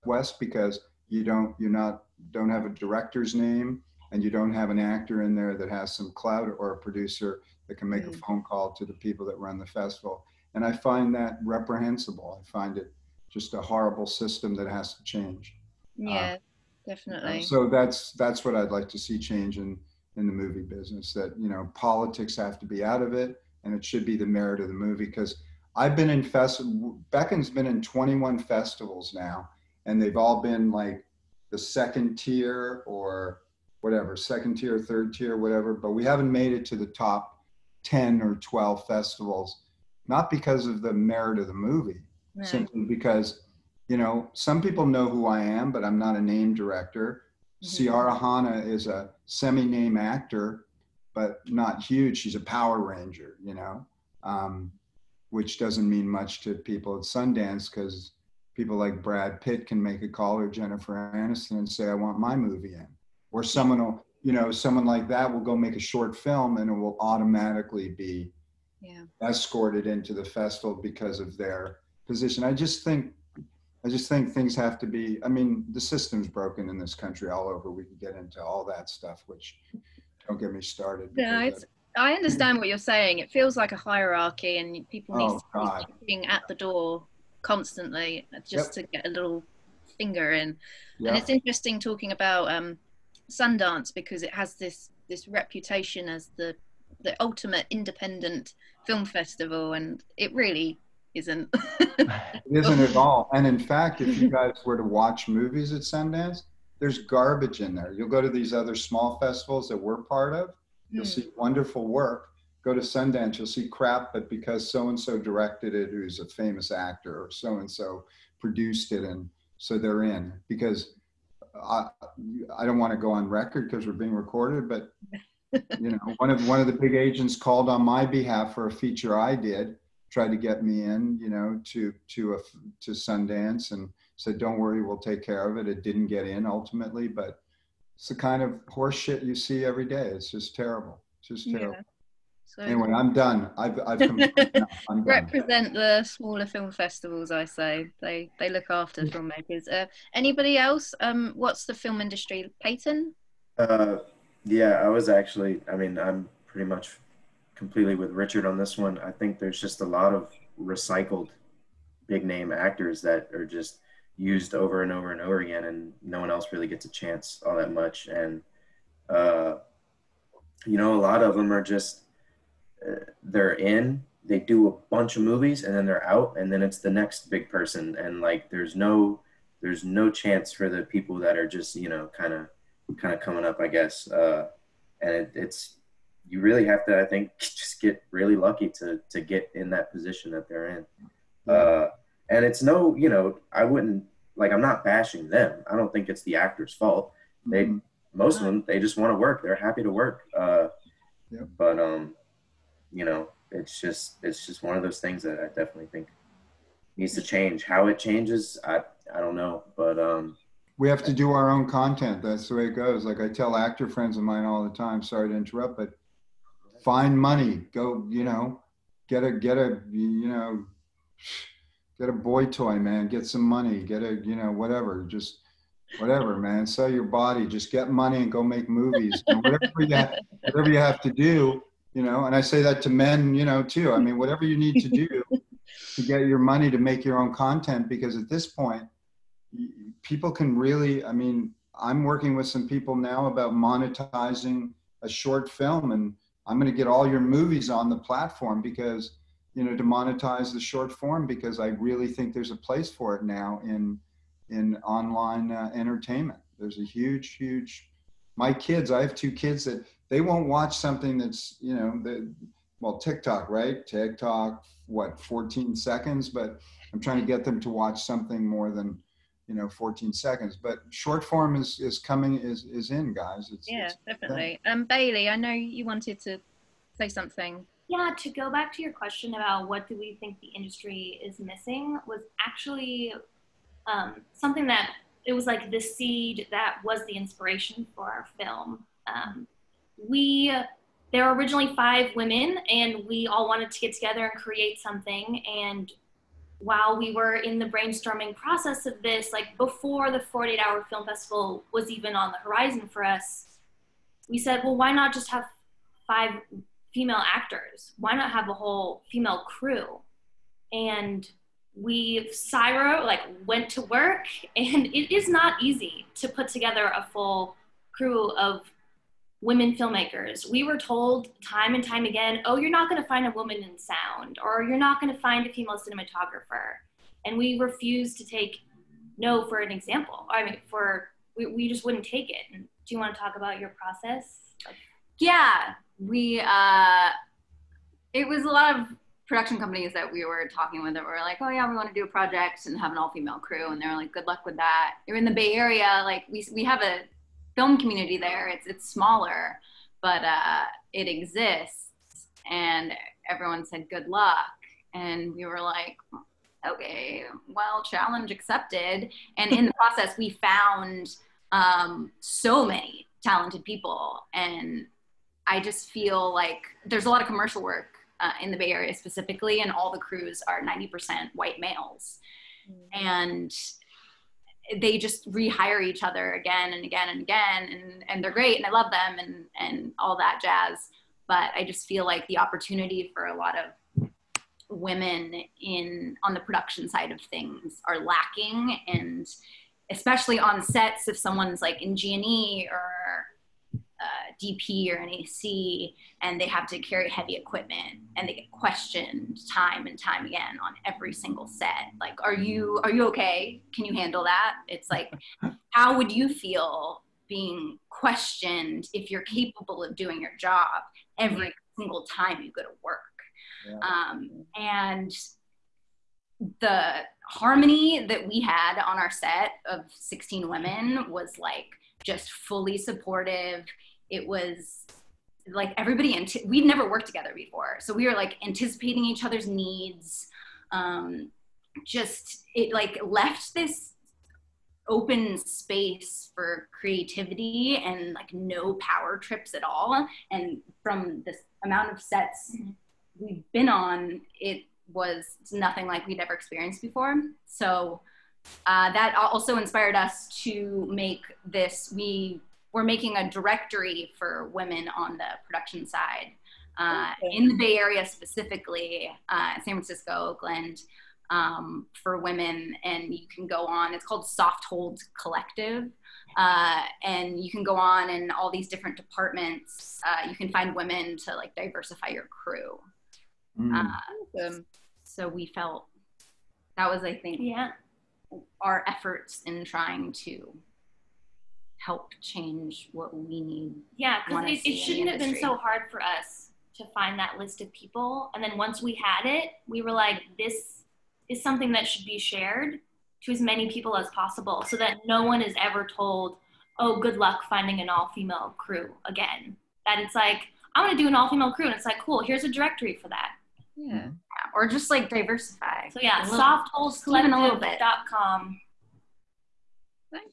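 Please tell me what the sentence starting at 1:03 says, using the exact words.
Or someone will, you know, someone like that will go make a short film and it will automatically be yeah.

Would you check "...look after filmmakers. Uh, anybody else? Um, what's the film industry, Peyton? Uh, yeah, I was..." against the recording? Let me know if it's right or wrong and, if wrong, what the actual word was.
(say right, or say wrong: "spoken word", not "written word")
right.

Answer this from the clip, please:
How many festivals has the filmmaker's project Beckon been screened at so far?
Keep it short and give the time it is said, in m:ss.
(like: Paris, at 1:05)
21, at 0:27.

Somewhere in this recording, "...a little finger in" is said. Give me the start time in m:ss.
1:29.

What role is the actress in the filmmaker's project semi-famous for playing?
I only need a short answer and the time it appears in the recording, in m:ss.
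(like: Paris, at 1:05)
Power Ranger, at 0:52.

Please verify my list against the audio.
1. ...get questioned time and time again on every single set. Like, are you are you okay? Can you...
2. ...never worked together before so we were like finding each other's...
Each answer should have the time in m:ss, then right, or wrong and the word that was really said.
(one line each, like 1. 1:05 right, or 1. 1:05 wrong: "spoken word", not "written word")
1. 6:38 right
2. 7:06 wrong: "anticipating", not "finding".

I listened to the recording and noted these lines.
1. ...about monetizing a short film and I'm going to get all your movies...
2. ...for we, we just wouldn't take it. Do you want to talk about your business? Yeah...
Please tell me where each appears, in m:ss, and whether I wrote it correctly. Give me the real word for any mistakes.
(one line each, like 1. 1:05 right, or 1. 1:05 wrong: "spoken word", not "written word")
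1. 4:03 right
2. 5:30 wrong: "process", not "business".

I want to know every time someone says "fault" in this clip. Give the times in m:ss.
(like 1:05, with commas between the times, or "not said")
3:16.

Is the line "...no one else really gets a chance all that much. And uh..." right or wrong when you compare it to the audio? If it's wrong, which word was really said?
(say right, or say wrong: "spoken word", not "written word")
right.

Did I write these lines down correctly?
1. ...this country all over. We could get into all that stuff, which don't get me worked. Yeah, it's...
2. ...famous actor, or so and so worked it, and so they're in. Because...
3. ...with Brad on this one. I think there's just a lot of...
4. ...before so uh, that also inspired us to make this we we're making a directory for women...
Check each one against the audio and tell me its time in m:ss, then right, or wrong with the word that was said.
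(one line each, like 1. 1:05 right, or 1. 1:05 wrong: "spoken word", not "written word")
1. 1:16 wrong: "started", not "worked"
2. 1:56 wrong: "produced", not "worked"
3. 2:37 wrong: "Richard", not "Brad"
4. 7:26 right.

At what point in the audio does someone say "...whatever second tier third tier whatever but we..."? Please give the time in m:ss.
0:33.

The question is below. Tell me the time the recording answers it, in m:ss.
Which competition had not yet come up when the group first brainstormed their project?
5:00.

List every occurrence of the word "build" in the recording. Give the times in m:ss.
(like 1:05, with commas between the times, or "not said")
not said.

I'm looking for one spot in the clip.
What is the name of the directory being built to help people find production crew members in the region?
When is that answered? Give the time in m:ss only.
7:44.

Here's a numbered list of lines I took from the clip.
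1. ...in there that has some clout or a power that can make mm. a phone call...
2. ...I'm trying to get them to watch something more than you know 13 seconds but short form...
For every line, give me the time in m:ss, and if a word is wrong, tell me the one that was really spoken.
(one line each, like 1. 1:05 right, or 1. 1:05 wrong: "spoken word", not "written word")
1. 0:05 wrong: "producer", not "power"
2. 4:26 wrong: "14", not "13".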